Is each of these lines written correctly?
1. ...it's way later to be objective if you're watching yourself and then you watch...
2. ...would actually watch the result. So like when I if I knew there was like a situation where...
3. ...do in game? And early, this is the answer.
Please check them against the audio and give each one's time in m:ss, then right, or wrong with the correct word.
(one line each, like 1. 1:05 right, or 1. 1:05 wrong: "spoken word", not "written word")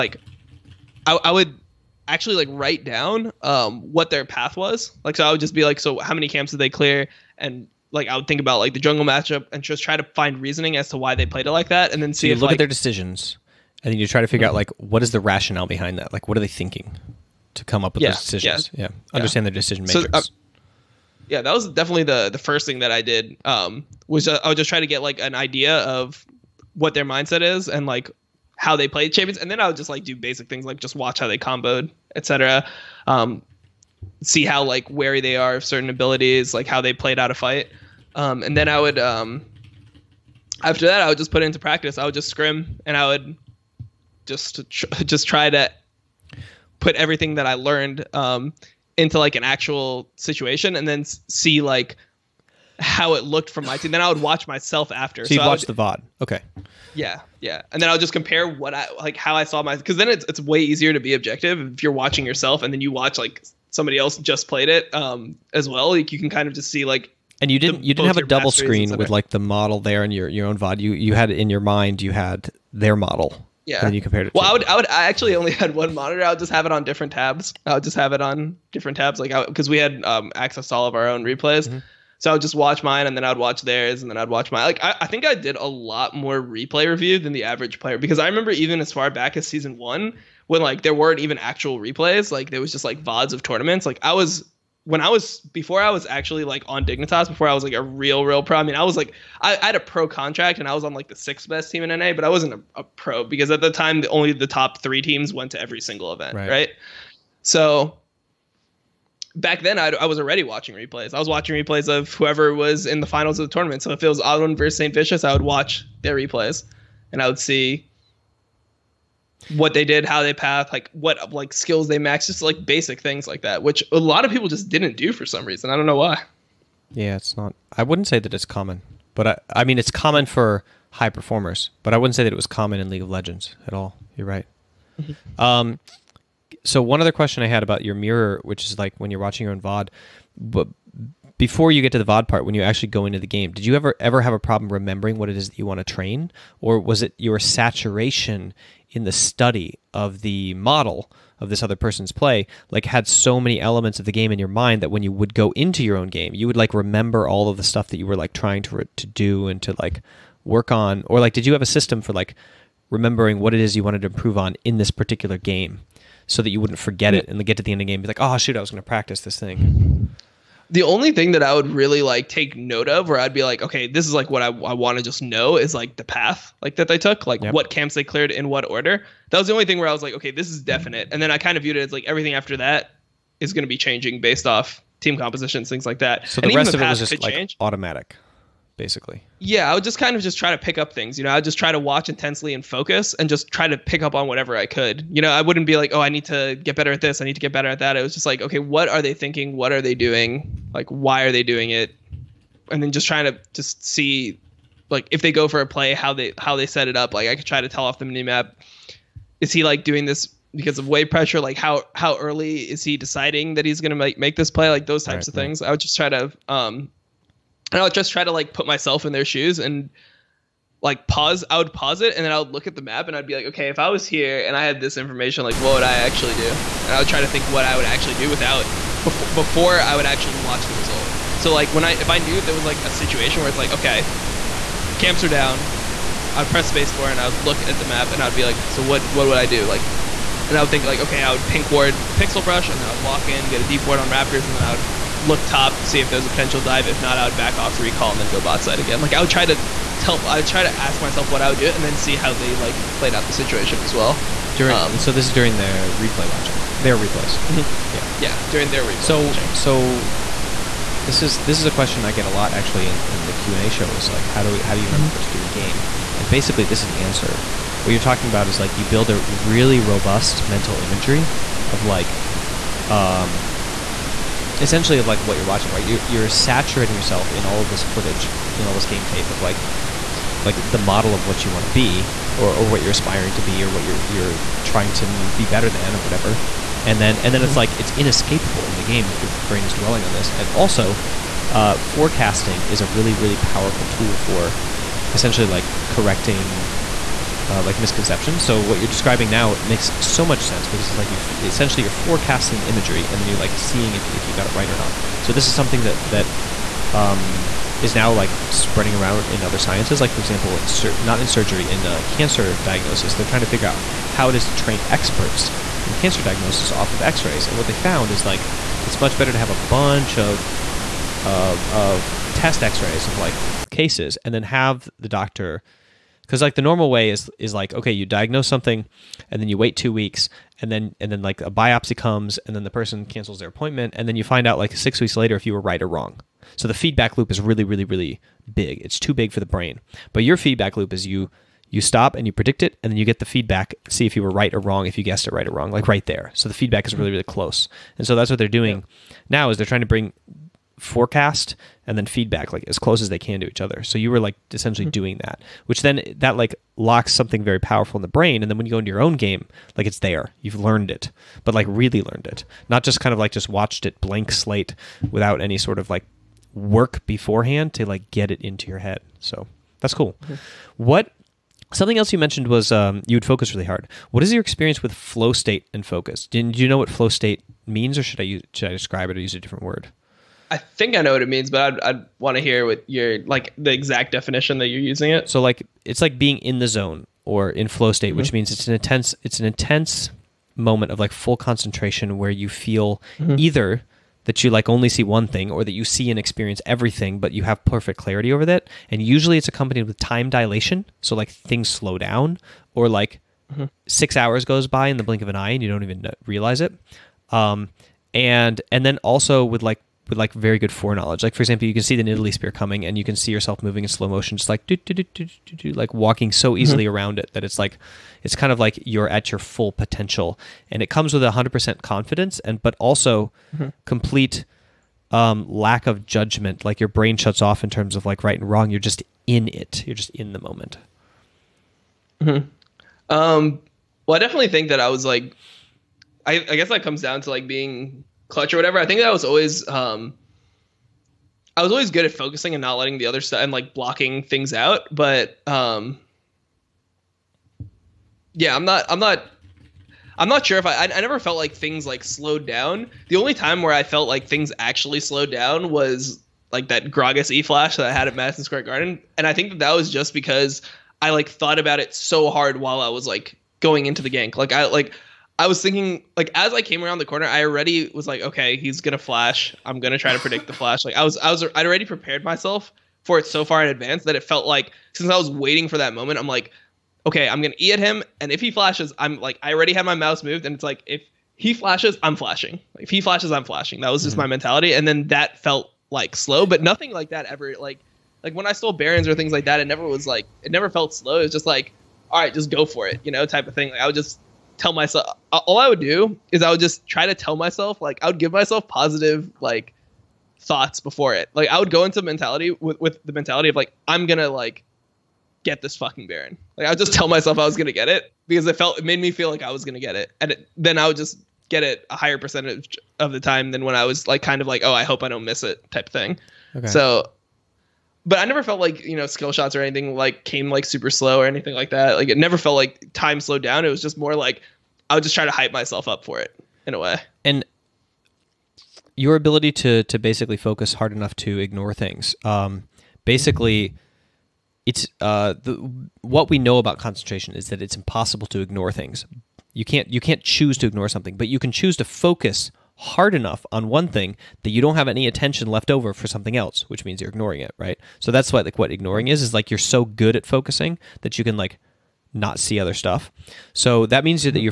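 1. 1:00 wrong: "easier", not "later"
2. 3:49 right
3. 4:25 wrong: "basically", not "early".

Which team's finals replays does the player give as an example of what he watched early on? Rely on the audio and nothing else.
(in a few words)
St. Vicious.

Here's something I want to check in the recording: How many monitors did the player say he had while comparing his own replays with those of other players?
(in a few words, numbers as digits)
1.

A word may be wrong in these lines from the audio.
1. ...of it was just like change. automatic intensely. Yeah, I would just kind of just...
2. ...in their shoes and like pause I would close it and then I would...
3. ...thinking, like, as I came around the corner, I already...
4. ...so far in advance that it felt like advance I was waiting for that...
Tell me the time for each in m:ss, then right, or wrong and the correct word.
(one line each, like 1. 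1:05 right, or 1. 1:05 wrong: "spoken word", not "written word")
1. 3:06 wrong: "basically", not "intensely"
2. 3:39 wrong: "pause", not "close"
3. 7:45 right
4. 7:53 wrong: "since", not "advance".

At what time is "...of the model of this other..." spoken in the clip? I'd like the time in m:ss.
2:29.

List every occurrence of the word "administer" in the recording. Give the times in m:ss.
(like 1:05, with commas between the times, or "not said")
not said.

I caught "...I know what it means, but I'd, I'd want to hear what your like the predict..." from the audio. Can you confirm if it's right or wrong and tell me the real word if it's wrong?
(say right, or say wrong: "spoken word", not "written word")
wrong: "exact", not "predict".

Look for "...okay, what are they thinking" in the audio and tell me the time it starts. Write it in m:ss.
3:18.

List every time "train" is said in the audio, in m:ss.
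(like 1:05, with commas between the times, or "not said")
2:25, 5:14.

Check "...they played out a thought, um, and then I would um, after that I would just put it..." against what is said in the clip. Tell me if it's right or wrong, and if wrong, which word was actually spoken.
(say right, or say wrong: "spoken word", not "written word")
wrong: "fight", not "thought".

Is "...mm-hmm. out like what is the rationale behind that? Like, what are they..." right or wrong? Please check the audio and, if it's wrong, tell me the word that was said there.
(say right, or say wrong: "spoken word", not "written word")
right.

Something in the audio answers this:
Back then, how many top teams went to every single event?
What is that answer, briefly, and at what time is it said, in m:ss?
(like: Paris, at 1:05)
3, at 1:44.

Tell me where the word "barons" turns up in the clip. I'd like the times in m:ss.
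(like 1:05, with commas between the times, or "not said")
8:08, 8:26.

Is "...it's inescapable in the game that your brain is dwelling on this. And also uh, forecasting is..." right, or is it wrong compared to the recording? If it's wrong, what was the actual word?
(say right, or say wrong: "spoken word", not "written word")
right.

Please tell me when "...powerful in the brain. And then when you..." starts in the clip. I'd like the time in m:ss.
5:57.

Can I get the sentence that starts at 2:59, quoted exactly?
That was the only thing where I was like, okay, this is mm-hmm.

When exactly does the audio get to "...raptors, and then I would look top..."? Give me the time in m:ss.
4:04.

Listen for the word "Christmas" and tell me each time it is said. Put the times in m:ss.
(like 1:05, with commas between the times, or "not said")
not said.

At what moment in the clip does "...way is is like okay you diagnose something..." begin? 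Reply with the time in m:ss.
5:26.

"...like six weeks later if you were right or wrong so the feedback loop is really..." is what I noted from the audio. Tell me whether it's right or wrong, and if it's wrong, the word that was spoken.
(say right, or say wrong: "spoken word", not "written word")
right.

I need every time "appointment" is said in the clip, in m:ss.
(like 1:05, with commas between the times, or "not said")
5:33.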